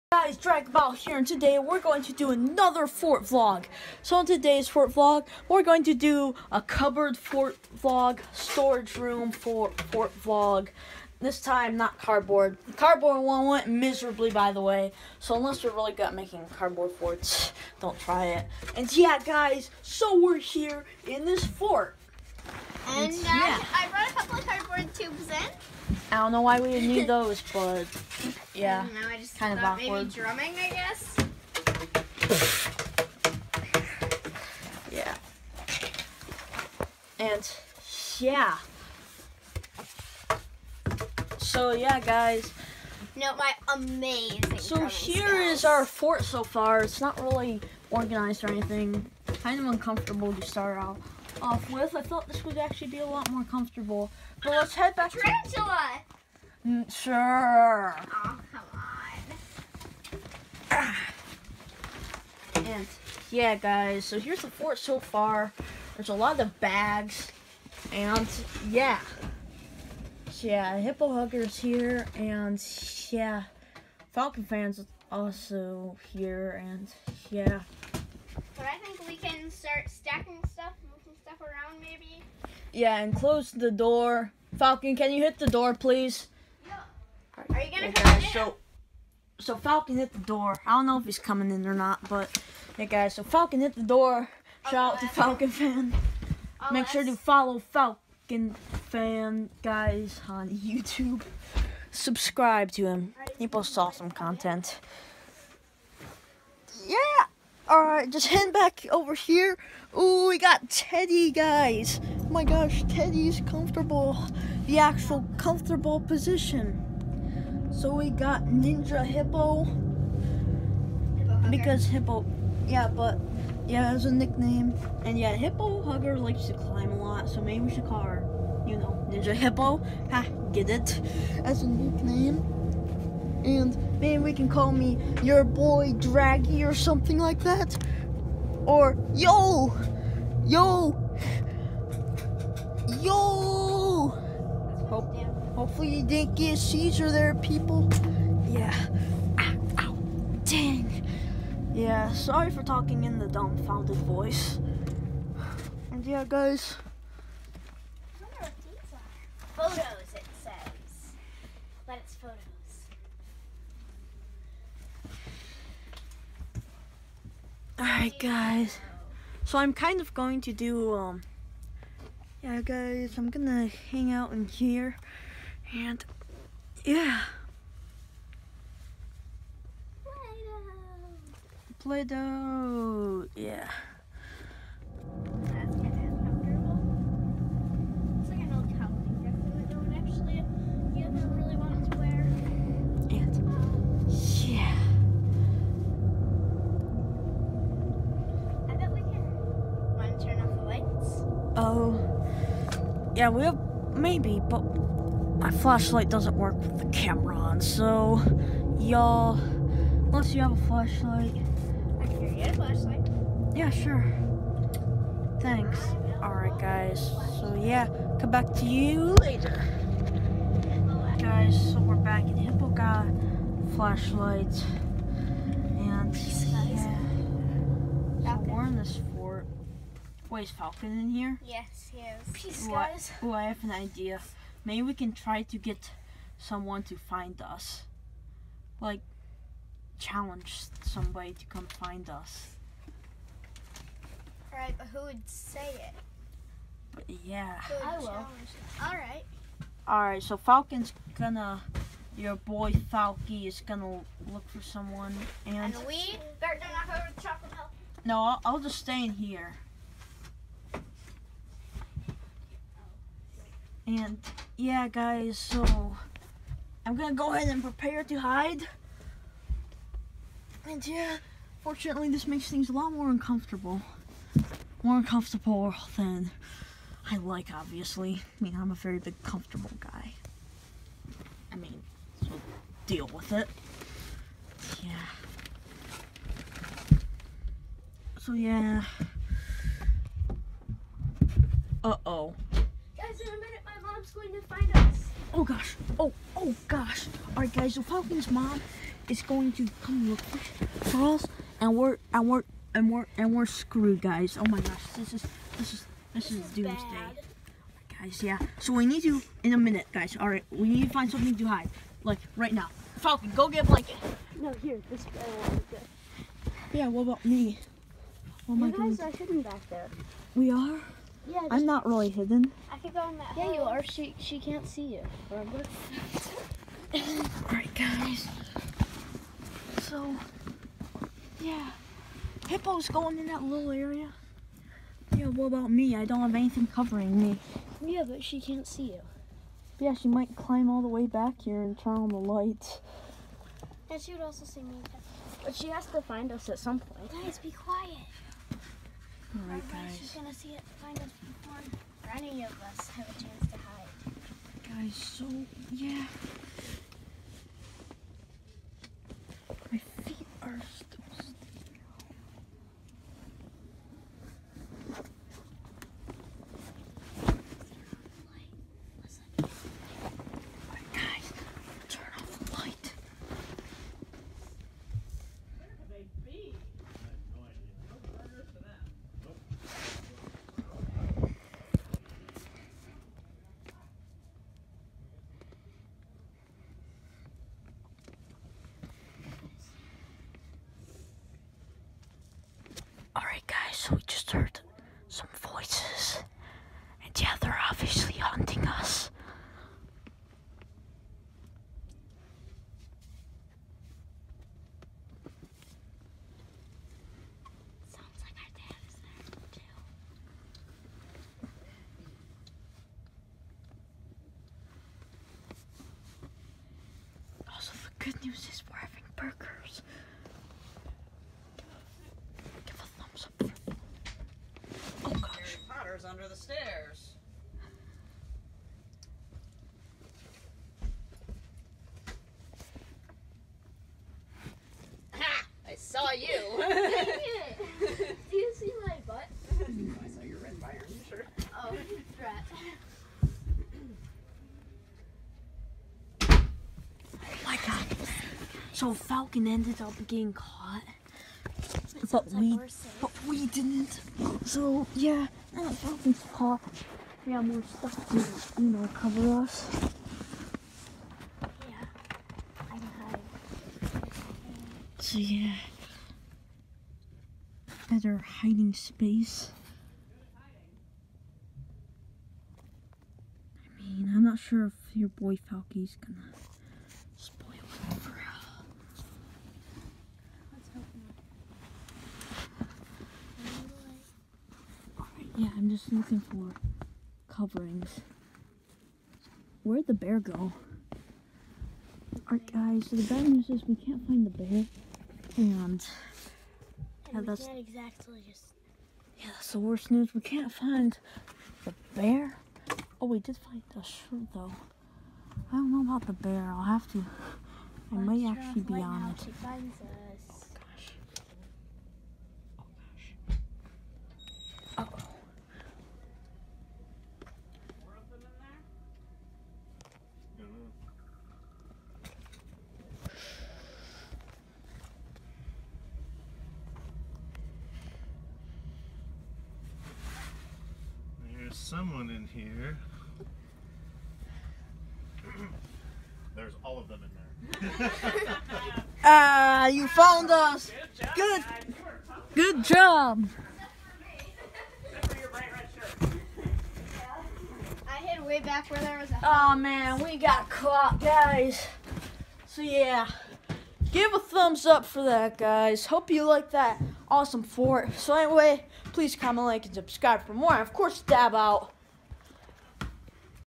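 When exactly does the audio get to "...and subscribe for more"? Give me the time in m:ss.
9:19.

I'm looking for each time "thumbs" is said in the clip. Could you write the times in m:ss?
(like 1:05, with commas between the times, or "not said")
9:14.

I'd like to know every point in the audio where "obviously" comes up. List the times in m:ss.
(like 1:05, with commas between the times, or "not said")
4:37, 6:37.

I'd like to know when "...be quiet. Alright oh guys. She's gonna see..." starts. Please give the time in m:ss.
5:47.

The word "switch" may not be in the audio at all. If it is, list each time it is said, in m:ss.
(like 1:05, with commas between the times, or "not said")
not said.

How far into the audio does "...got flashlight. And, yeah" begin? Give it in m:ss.
3:42.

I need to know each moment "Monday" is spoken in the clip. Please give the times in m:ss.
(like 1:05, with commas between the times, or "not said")
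not said.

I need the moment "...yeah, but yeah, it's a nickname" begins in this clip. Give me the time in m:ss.
2:02.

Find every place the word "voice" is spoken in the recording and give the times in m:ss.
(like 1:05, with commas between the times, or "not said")
2:33, 6:35.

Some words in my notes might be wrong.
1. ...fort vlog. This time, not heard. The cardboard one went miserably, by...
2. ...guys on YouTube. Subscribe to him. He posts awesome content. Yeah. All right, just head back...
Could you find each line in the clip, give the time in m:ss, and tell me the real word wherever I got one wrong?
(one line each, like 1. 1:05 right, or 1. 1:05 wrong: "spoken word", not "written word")
1. 0:09 wrong: "cardboard", not "heard"
2. 1:39 right.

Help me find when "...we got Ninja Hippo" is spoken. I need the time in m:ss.
1:57.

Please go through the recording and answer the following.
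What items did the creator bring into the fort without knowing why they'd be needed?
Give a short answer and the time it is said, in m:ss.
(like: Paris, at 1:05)
Cardboard tubes, at 0:24.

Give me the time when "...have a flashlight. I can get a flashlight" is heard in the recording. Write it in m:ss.
3:30.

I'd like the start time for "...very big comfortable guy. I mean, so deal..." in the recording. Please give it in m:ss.
4:38.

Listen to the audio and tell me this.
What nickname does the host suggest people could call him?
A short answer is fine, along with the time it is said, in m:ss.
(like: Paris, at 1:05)
Draggy, at 2:15.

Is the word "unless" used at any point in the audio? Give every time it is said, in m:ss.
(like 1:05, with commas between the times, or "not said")
0:15, 3:29.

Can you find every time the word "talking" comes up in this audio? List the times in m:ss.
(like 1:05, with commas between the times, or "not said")
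2:32.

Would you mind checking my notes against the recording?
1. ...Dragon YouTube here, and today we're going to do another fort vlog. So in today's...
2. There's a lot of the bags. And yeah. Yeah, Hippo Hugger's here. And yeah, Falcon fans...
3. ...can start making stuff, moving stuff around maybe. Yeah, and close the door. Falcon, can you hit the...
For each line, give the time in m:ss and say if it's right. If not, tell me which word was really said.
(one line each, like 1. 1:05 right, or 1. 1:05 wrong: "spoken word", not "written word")
1. 0:00 wrong: "Battle", not "YouTube"
2. 1:05 right
3. 1:19 wrong: "stacking", not "making".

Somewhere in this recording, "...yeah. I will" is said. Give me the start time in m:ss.
4:07.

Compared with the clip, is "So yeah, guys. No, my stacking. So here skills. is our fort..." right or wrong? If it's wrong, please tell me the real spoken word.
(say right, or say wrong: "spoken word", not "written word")
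wrong: "amazing", not "stacking".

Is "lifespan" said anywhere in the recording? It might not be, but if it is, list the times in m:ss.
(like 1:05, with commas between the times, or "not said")
not said.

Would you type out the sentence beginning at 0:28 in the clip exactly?
I know, I just kind of awkward.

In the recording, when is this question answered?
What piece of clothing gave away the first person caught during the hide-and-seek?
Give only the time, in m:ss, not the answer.
7:20.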